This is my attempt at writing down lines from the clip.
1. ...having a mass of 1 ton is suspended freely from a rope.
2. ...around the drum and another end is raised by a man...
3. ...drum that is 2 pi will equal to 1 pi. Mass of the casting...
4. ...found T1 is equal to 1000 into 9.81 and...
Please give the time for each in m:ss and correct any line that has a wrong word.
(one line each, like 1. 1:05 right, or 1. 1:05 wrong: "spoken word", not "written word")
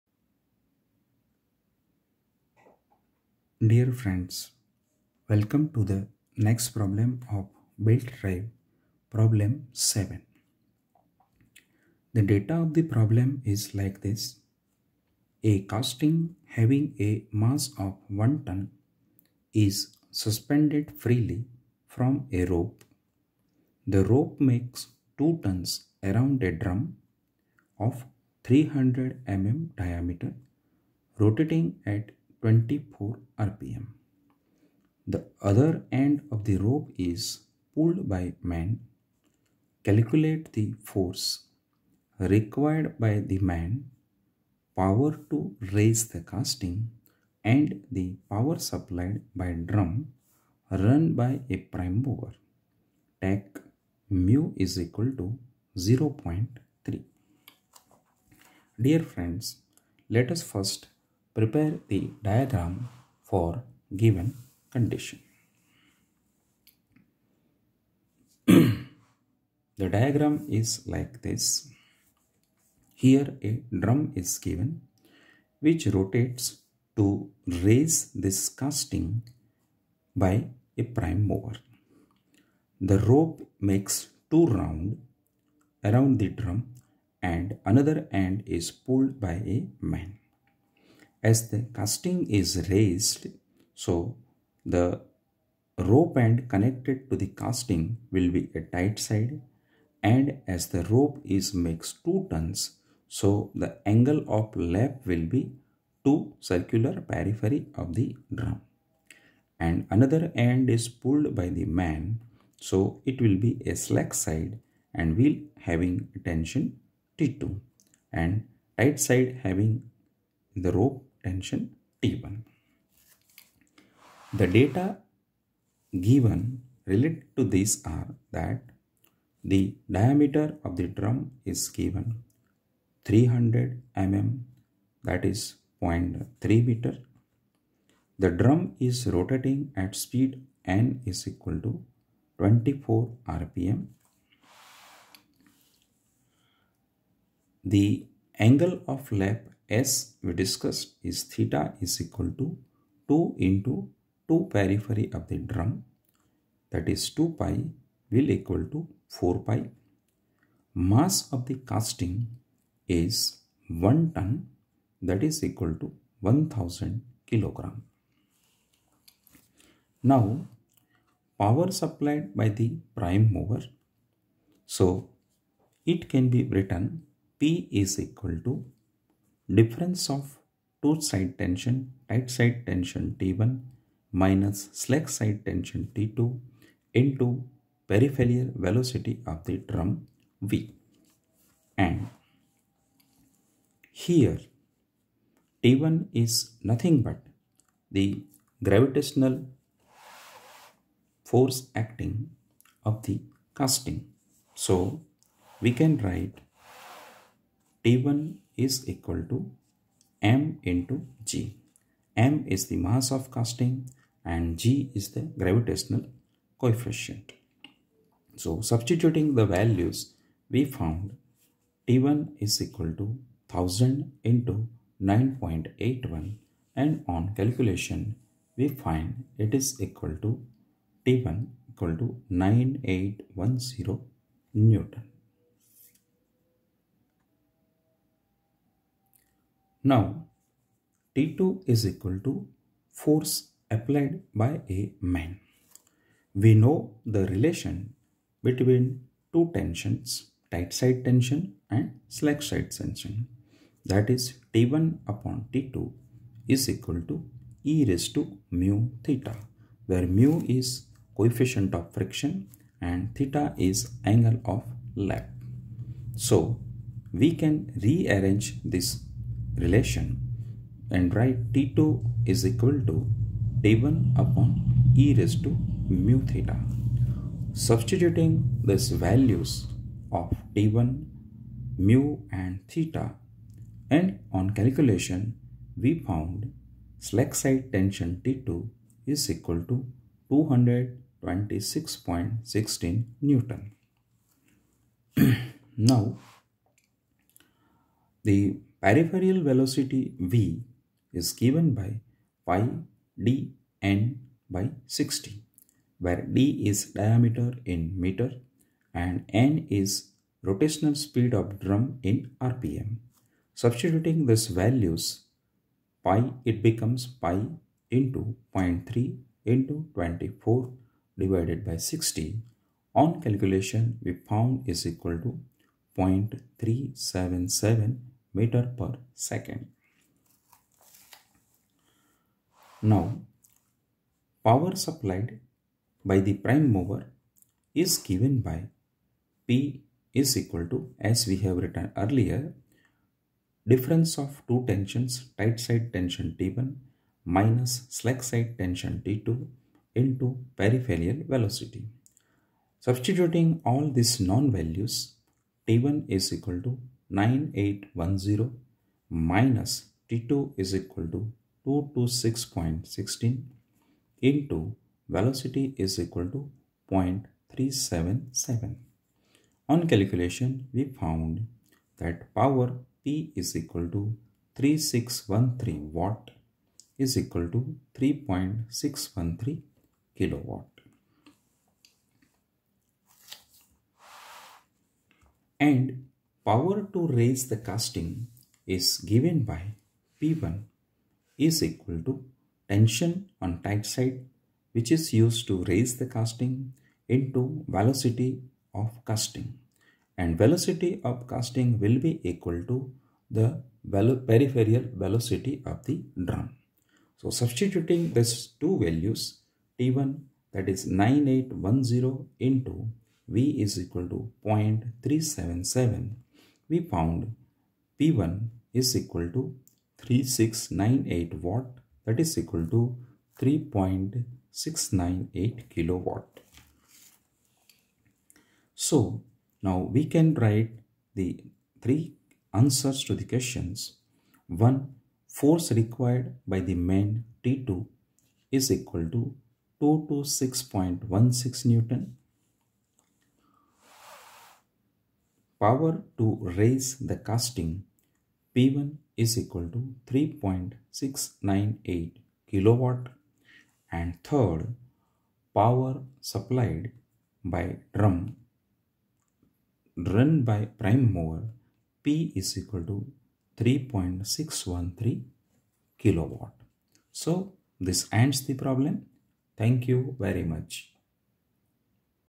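1. 0:16 right
2. 1:25 wrong: "pulled", not "raised"
3. 2:35 wrong: "4", not "1"
4. 3:40 right.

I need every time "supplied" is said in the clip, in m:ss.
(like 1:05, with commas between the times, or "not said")
0:48, 2:51, 5:34, 7:36.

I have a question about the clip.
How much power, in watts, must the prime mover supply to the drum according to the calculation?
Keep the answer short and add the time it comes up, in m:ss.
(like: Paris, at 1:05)
3613 W, at 6:14.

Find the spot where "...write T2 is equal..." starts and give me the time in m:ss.
4:31.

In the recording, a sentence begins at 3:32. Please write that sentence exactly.
m is the mass of casting and g is the gravitational coefficient.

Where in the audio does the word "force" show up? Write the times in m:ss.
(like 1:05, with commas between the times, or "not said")
0:40, 3:21, 4:02, 7:15.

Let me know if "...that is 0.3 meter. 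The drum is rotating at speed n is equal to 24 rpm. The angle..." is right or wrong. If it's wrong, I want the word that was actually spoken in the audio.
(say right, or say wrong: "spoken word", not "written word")
right.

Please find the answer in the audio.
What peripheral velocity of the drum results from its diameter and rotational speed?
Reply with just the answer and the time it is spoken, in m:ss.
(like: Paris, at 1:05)
0.377 m/s, at 5:25.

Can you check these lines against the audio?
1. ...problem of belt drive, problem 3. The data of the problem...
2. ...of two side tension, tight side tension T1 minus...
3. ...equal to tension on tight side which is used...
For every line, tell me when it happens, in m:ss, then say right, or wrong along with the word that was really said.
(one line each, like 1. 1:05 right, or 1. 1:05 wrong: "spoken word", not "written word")
1. 0:06 wrong: "7", not "3"
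2. 3:00 right
3. 6:31 right.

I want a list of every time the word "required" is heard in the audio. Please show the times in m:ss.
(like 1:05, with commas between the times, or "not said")
0:42, 7:15.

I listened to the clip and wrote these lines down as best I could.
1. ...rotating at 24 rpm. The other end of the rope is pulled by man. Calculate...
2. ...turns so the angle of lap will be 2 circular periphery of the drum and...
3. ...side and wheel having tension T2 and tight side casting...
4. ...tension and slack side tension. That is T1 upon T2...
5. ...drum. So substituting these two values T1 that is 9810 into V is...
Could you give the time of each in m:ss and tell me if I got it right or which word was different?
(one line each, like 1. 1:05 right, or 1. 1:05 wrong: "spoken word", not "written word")
1. 0:31 right
2. 1:42 right
3. 1:54 wrong: "having", not "casting"
4. 4:11 right
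5. 6:46 right.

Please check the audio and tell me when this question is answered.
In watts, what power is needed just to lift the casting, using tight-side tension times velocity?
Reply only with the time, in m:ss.
7:00.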